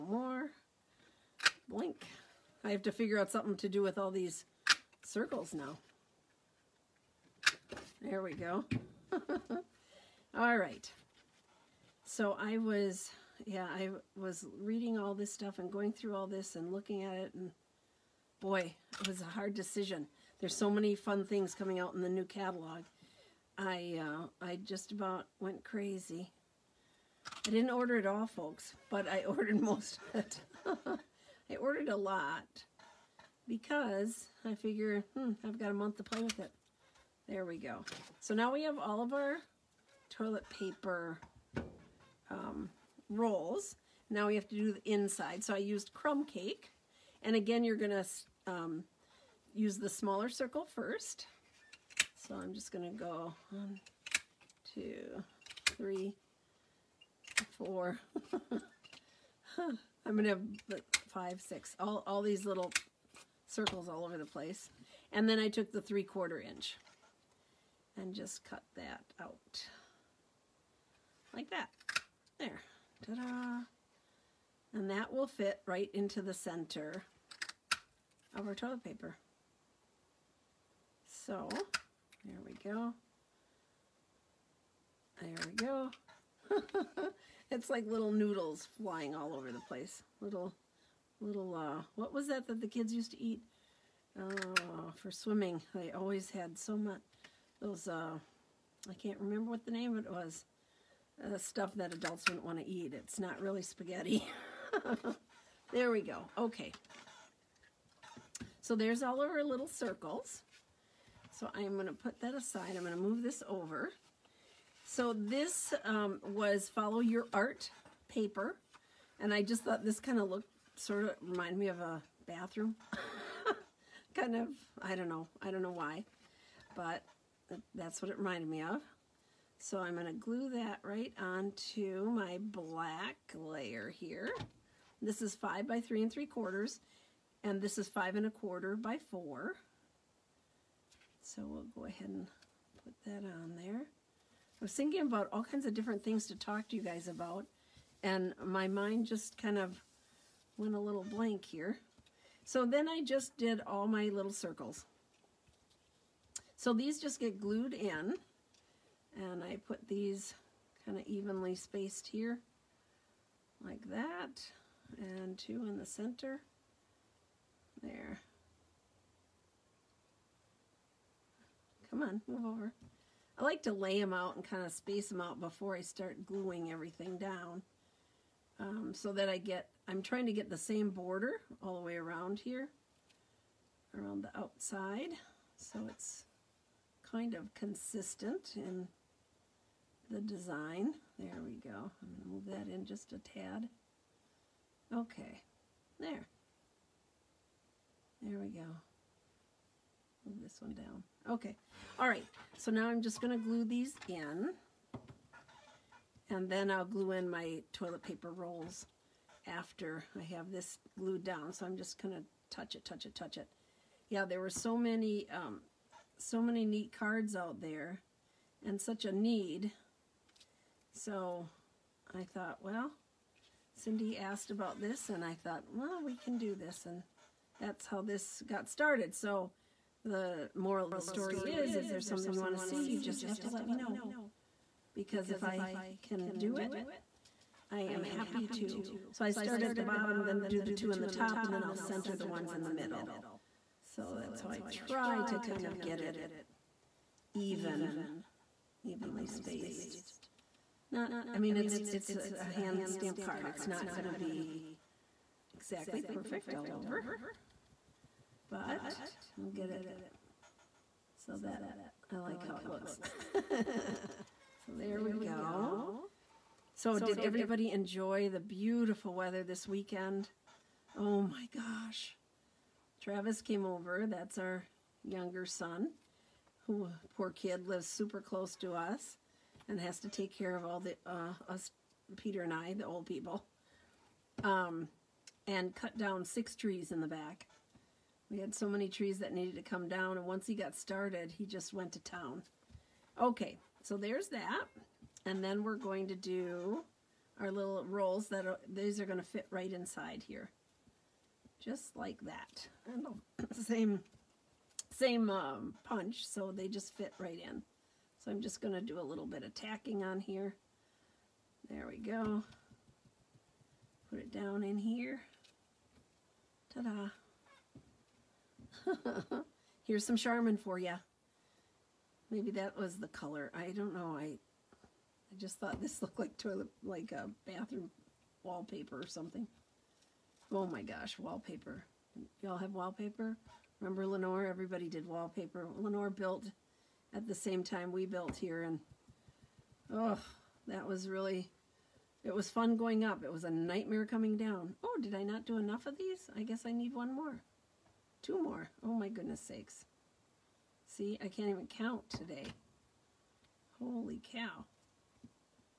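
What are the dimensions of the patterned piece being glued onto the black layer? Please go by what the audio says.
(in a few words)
5 by 3 3/4.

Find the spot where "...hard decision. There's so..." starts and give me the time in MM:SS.
00:19.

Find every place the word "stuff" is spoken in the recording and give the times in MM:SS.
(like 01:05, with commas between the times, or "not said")
00:15, 01:41.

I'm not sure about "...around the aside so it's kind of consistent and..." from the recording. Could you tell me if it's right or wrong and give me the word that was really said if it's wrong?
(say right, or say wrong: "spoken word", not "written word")
wrong: "outside", not "aside".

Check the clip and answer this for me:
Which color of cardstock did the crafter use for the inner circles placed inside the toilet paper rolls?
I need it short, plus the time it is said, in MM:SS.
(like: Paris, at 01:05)
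Crumb Cake, at 00:45.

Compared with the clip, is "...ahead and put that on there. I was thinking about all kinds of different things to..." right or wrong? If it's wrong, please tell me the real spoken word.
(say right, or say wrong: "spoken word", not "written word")
right.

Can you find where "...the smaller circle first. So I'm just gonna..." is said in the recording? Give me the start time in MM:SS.
00:49.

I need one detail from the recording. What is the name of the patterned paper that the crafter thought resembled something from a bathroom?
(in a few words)
Follow Your Art.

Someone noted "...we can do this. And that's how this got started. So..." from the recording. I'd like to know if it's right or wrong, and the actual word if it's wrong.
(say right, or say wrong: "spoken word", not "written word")
right.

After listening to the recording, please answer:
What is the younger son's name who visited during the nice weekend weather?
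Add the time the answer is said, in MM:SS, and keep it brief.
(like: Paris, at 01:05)
Travis, at 04:33.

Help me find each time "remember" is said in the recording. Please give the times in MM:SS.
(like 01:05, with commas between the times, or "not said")
01:39, 05:33.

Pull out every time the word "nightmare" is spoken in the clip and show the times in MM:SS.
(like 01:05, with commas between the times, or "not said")
05:43.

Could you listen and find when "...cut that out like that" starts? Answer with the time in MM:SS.
01:08.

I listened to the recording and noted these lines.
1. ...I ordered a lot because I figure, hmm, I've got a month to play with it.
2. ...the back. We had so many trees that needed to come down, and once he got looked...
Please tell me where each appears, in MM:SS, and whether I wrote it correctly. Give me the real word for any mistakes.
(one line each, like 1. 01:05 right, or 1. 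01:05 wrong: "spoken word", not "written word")
1. 00:31 right
2. 04:46 wrong: "started", not "looked".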